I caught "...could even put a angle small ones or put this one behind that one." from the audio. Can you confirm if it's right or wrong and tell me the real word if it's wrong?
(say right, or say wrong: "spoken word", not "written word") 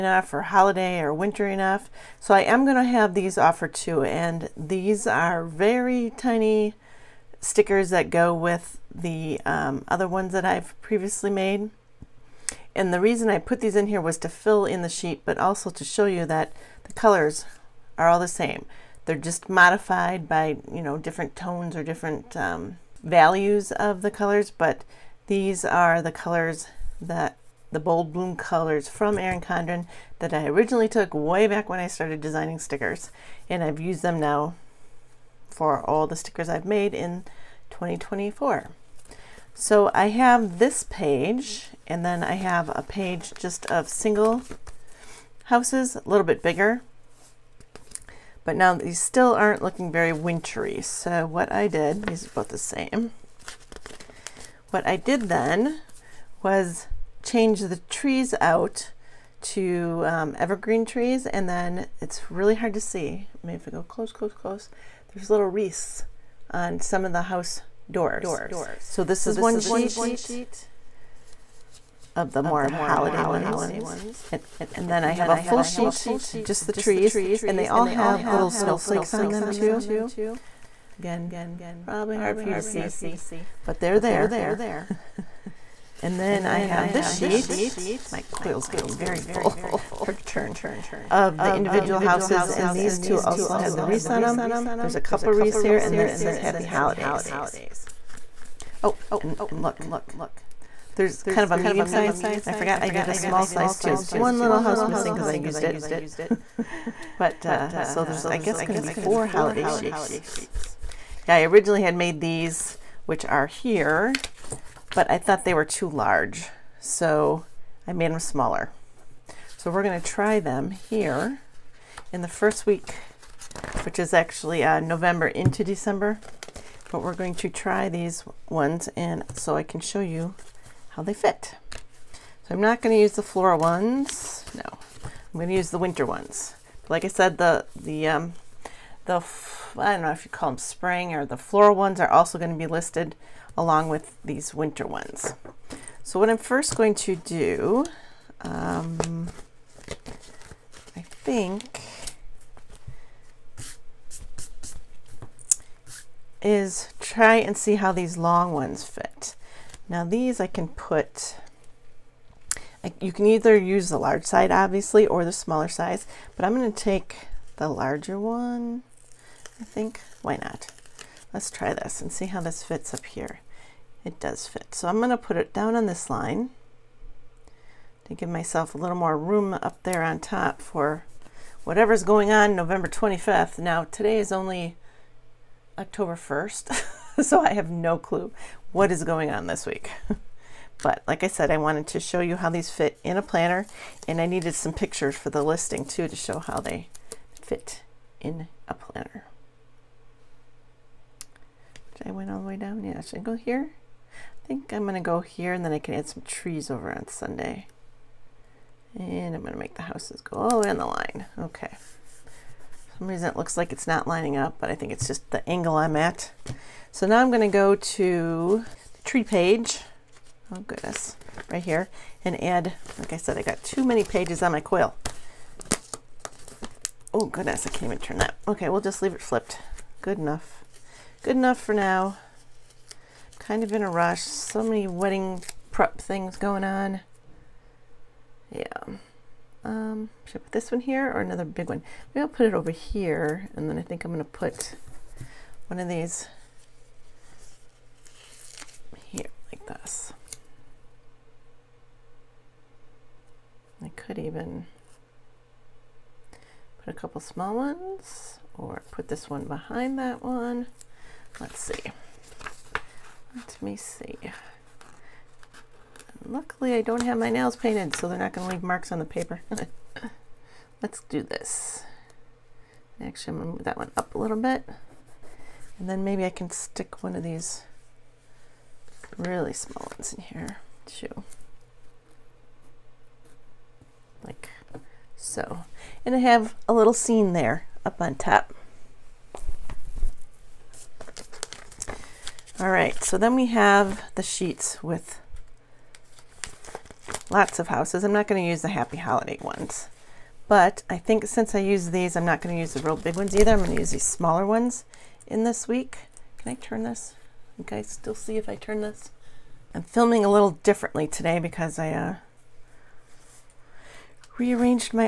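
wrong: "couple", not "angle".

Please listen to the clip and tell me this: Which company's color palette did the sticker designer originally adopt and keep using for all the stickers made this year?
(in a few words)
Erin Condren.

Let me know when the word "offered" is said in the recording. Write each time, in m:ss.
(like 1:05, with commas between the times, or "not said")
0:03.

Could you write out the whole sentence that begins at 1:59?
So we're going to try them here in the first week, which is actually uh, November into December.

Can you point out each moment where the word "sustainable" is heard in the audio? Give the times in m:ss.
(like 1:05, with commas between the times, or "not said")
not said.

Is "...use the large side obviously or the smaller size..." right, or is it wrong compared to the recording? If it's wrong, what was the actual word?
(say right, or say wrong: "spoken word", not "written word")
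right.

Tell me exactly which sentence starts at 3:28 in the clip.
And I'm gonna make the houses go all the way on the line.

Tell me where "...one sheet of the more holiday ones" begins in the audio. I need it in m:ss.
1:09.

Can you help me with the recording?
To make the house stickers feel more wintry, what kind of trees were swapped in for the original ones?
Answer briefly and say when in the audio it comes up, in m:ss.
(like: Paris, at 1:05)
evergreen trees, at 1:00.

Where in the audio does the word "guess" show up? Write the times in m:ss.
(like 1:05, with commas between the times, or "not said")
1:48.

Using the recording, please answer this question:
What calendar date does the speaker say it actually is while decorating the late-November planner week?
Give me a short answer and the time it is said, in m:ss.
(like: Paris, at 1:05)
October 1st, at 3:05.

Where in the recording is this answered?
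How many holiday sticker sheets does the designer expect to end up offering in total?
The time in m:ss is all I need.
1:48.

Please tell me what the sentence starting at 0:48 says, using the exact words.
But now these still aren't looking very wintry.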